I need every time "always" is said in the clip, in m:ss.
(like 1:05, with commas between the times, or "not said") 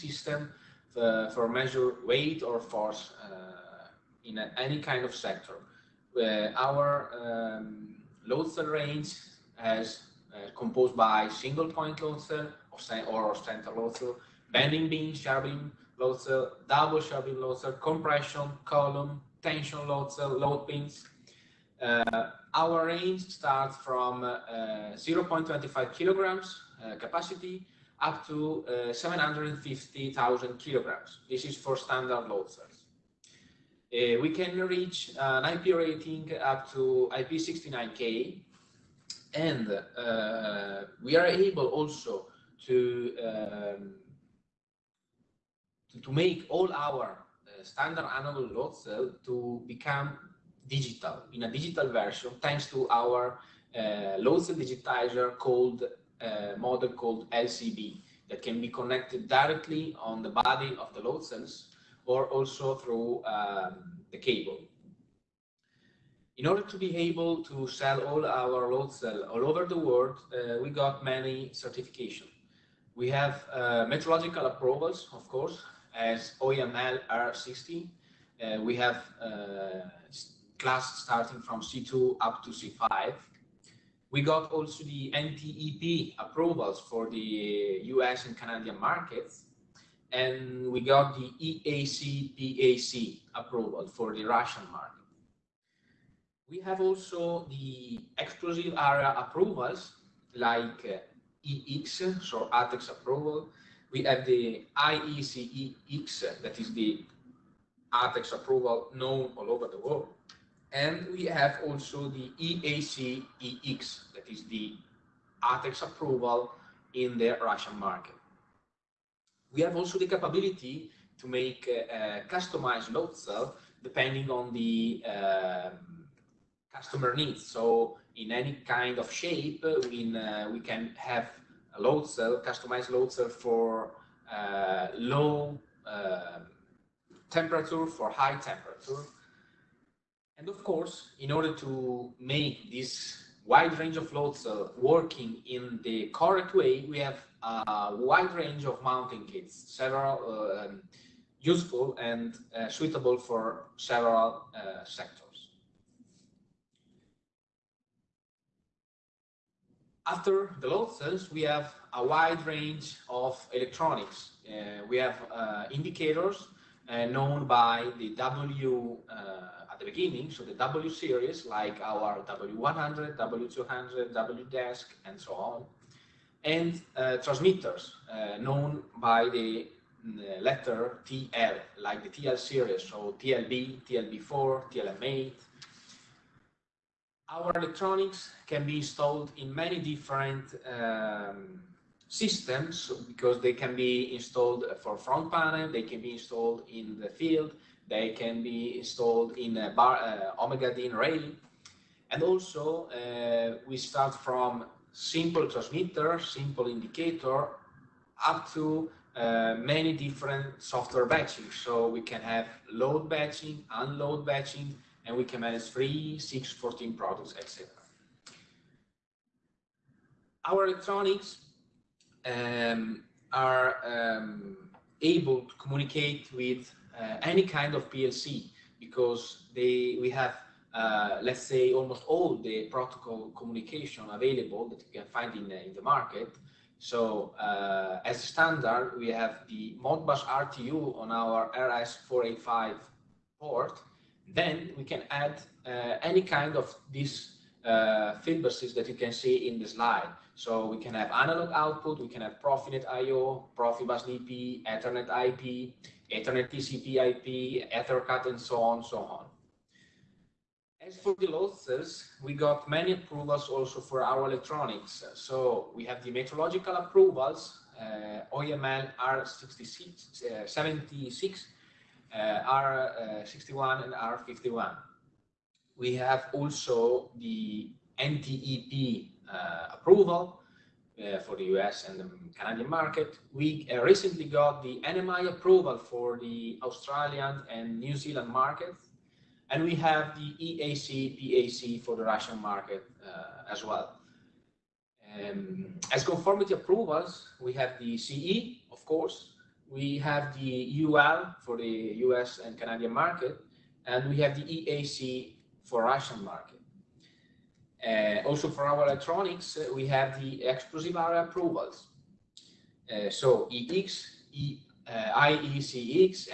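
not said.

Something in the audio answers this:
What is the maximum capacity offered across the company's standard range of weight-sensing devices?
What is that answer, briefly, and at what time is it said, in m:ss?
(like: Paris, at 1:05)
750,000 kg, at 0:28.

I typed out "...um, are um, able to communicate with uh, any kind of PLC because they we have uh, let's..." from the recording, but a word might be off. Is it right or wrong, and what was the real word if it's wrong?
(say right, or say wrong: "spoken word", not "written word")
right.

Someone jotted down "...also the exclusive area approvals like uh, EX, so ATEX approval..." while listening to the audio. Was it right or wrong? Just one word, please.
right.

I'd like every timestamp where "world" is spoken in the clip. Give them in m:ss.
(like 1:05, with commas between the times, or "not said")
1:09, 1:49.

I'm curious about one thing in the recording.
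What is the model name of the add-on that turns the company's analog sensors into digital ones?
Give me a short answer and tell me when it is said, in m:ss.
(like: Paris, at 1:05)
LCB, at 0:57.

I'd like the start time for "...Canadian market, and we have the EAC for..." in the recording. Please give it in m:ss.
5:02.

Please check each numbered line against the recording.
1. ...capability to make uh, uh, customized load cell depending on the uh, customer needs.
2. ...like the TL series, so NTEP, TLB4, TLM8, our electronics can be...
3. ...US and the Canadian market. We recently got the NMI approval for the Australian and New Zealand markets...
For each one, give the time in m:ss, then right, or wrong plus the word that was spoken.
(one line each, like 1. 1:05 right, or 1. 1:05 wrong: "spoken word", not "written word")
1. 2:00 right
2. 3:01 wrong: "TLB", not "NTEP"
3. 4:41 right.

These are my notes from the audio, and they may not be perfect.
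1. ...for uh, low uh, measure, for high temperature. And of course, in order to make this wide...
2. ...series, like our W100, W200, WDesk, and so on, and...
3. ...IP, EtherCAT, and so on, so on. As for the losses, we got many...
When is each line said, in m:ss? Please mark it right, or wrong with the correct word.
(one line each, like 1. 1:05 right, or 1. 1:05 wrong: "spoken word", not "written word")
1. 2:13 wrong: "temperature", not "measure"
2. 2:50 right
3. 4:16 right.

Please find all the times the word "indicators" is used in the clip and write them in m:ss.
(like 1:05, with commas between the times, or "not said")
2:45, 3:26.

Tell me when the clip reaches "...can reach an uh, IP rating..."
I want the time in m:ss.
0:34.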